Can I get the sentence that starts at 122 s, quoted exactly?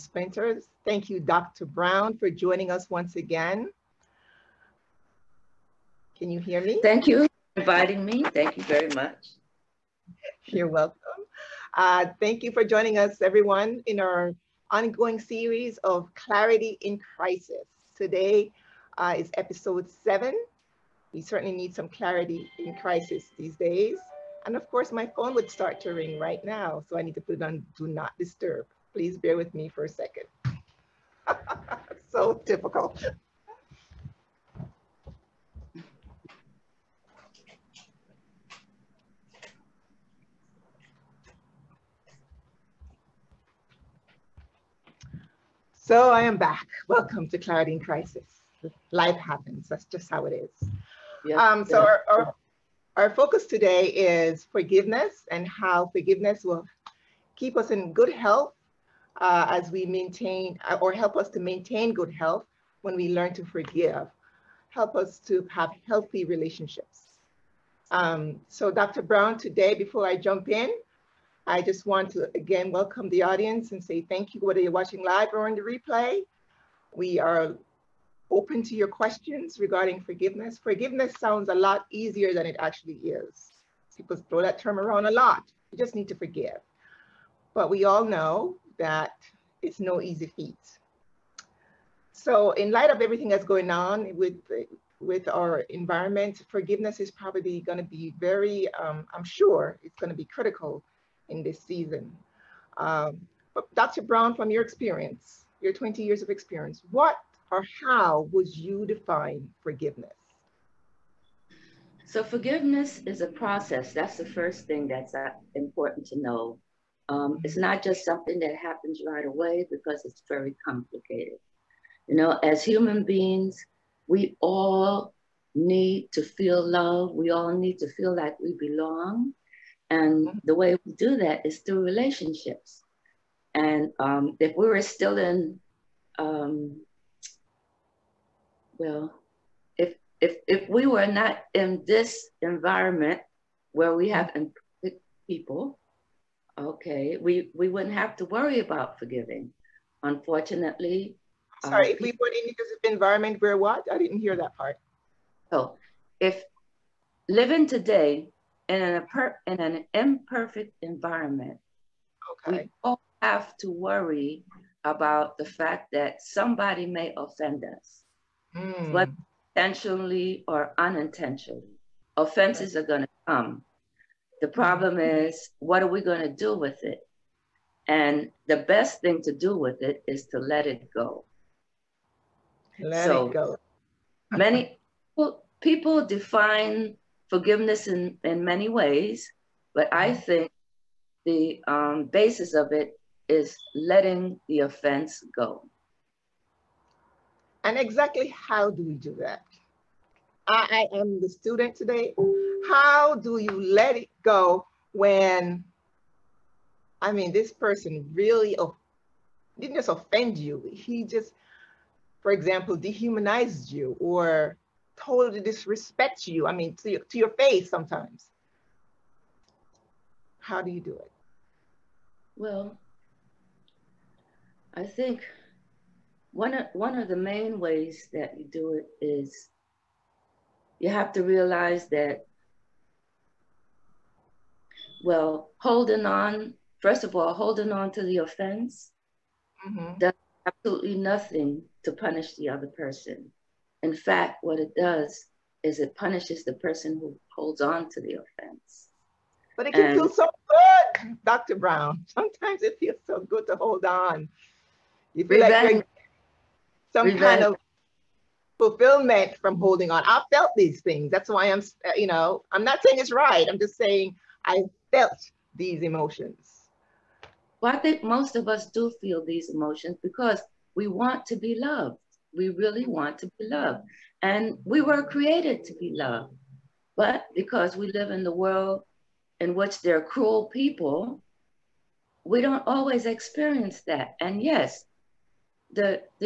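You know, as human beings, we all need to feel love.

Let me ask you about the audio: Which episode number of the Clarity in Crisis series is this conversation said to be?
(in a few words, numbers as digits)
7.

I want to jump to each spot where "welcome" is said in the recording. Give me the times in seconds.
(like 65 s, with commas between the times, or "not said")
10 s, 46 s, 72 s.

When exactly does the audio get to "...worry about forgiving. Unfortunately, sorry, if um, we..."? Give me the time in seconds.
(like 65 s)
148 s.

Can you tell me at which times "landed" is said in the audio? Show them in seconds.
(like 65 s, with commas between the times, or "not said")
not said.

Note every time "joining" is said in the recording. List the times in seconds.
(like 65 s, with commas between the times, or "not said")
2 s, 12 s.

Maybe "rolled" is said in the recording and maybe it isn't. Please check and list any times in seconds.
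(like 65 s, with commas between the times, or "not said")
not said.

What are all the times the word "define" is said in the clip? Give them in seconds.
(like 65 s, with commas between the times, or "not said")
108 s, 186 s.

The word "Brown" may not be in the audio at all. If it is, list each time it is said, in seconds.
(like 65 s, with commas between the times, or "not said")
1 s, 69 s, 104 s, 251 s.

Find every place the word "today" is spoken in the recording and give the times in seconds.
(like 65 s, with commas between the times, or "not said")
17 s, 53 s, 69 s, 157 s, 201 s.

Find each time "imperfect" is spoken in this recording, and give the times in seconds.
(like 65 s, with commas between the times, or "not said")
144 s, 159 s.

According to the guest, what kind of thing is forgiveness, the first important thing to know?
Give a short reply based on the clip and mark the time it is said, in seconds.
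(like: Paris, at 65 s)
A process, at 113 s.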